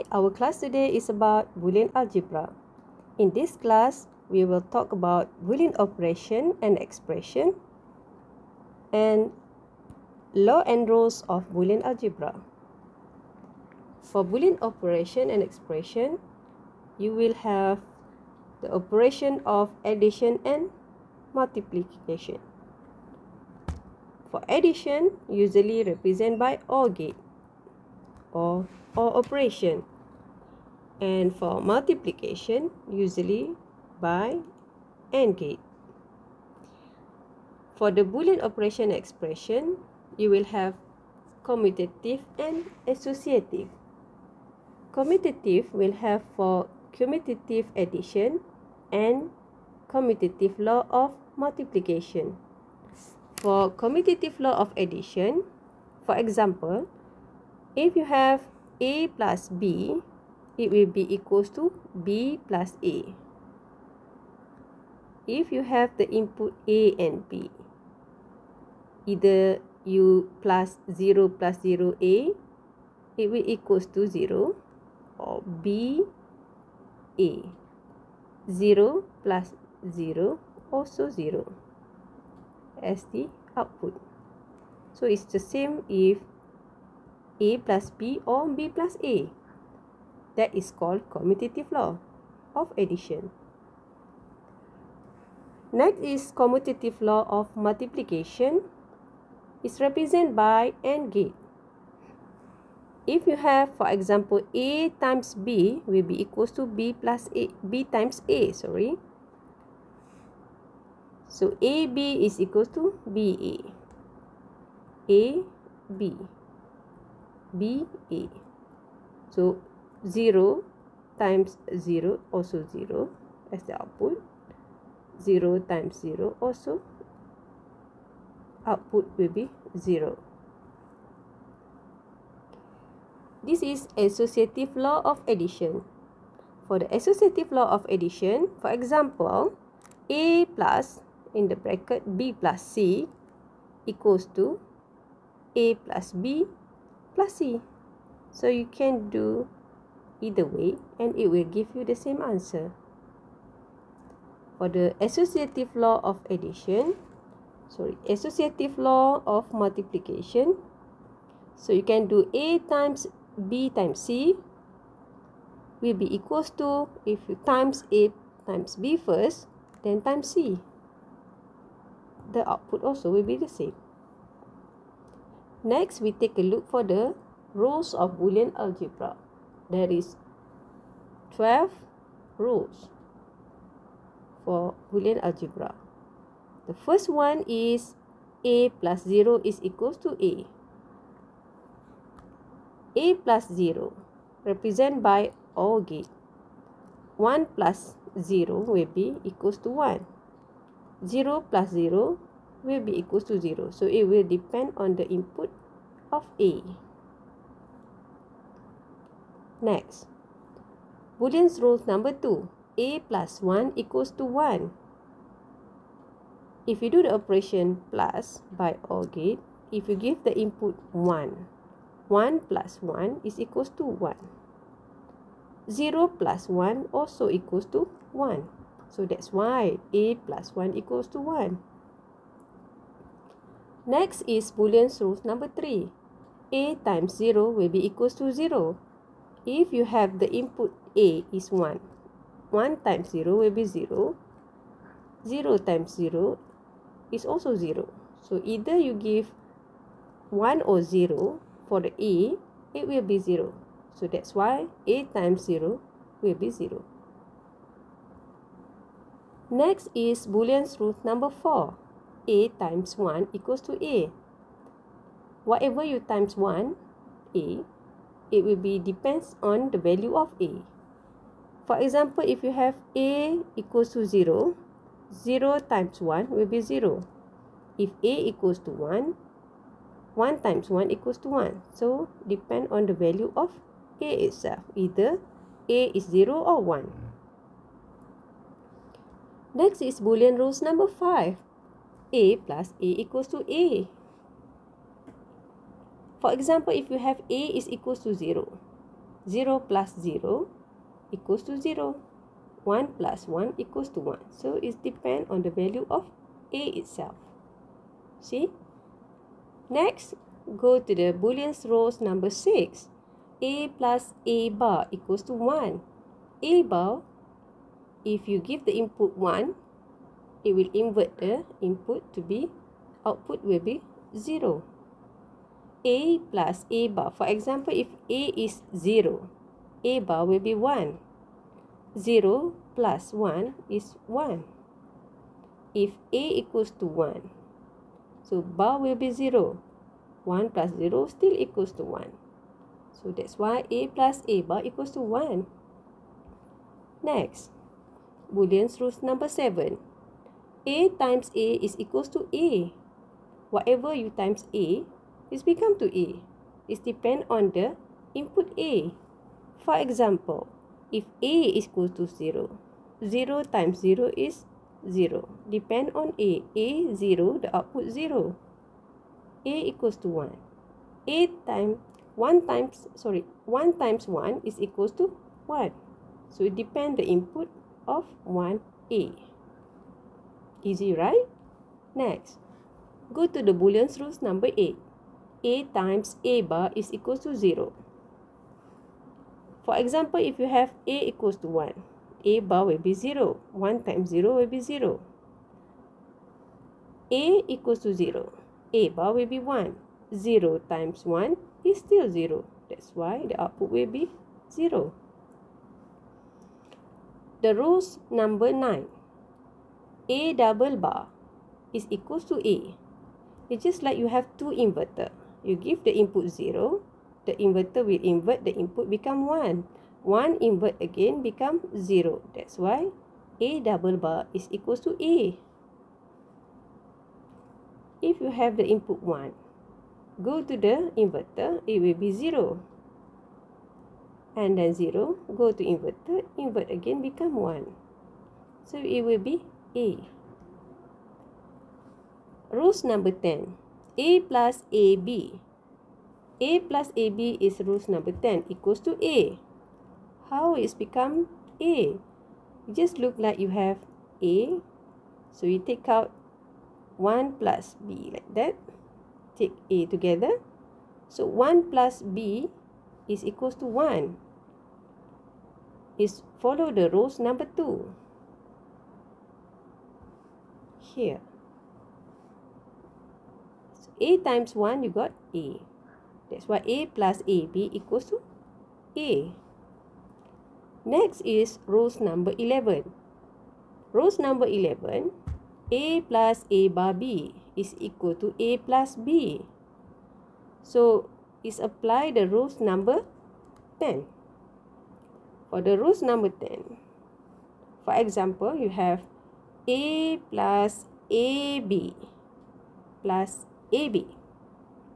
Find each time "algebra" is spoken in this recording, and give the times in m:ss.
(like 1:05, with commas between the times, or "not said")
0:01, 0:11, 2:58, 3:05.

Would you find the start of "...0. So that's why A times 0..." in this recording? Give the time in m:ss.
4:13.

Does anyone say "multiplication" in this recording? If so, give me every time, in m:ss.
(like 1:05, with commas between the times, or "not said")
0:21, 0:31, 0:51, 1:37, 2:39.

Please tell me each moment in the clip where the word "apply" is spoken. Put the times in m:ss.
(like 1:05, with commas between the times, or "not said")
8:11.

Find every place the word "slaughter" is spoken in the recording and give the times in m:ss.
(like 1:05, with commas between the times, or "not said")
not said.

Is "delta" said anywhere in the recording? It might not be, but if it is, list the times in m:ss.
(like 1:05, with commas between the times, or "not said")
not said.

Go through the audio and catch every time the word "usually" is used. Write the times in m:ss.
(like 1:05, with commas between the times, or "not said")
0:25, 0:32.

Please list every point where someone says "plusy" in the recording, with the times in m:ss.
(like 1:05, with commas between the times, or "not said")
2:27.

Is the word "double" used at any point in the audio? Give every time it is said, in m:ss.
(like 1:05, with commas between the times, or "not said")
6:50, 7:03.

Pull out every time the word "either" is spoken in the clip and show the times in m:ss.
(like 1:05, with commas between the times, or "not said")
1:09, 2:30, 4:08, 4:44.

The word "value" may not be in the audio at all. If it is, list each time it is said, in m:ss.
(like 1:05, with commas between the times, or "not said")
4:29, 4:42, 5:05.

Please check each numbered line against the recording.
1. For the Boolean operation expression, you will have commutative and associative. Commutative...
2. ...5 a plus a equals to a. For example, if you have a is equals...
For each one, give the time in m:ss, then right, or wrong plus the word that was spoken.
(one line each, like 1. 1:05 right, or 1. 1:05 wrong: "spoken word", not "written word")
1. 0:37 right
2. 4:50 right.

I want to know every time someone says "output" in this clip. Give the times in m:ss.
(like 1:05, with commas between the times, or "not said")
1:23, 2:03, 2:08, 2:52, 5:23, 6:07, 6:43.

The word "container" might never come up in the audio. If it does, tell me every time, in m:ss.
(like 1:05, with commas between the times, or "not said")
not said.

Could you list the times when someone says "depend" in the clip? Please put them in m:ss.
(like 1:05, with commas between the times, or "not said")
3:24, 4:28, 4:42, 5:04, 5:56, 6:05, 6:16.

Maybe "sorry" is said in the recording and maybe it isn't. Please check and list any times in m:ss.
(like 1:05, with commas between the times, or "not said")
1:48, 2:37, 6:12.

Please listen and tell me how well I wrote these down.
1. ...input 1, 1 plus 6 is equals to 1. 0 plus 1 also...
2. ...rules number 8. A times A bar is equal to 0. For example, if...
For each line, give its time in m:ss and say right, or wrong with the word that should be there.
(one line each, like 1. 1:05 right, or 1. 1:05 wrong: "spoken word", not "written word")
1. 3:40 wrong: "1", not "6"
2. 6:23 right.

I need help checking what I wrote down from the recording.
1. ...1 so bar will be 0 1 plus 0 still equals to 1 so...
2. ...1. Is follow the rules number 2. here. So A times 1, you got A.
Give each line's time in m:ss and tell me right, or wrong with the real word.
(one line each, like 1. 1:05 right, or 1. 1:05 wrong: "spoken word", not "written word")
1. 5:36 right
2. 7:43 right.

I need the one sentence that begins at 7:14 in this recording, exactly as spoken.
And then 0, go to inverter, invert again become 1.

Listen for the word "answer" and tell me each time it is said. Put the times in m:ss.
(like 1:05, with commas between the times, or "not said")
2:32.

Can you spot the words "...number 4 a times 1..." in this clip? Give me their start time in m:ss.
4:21.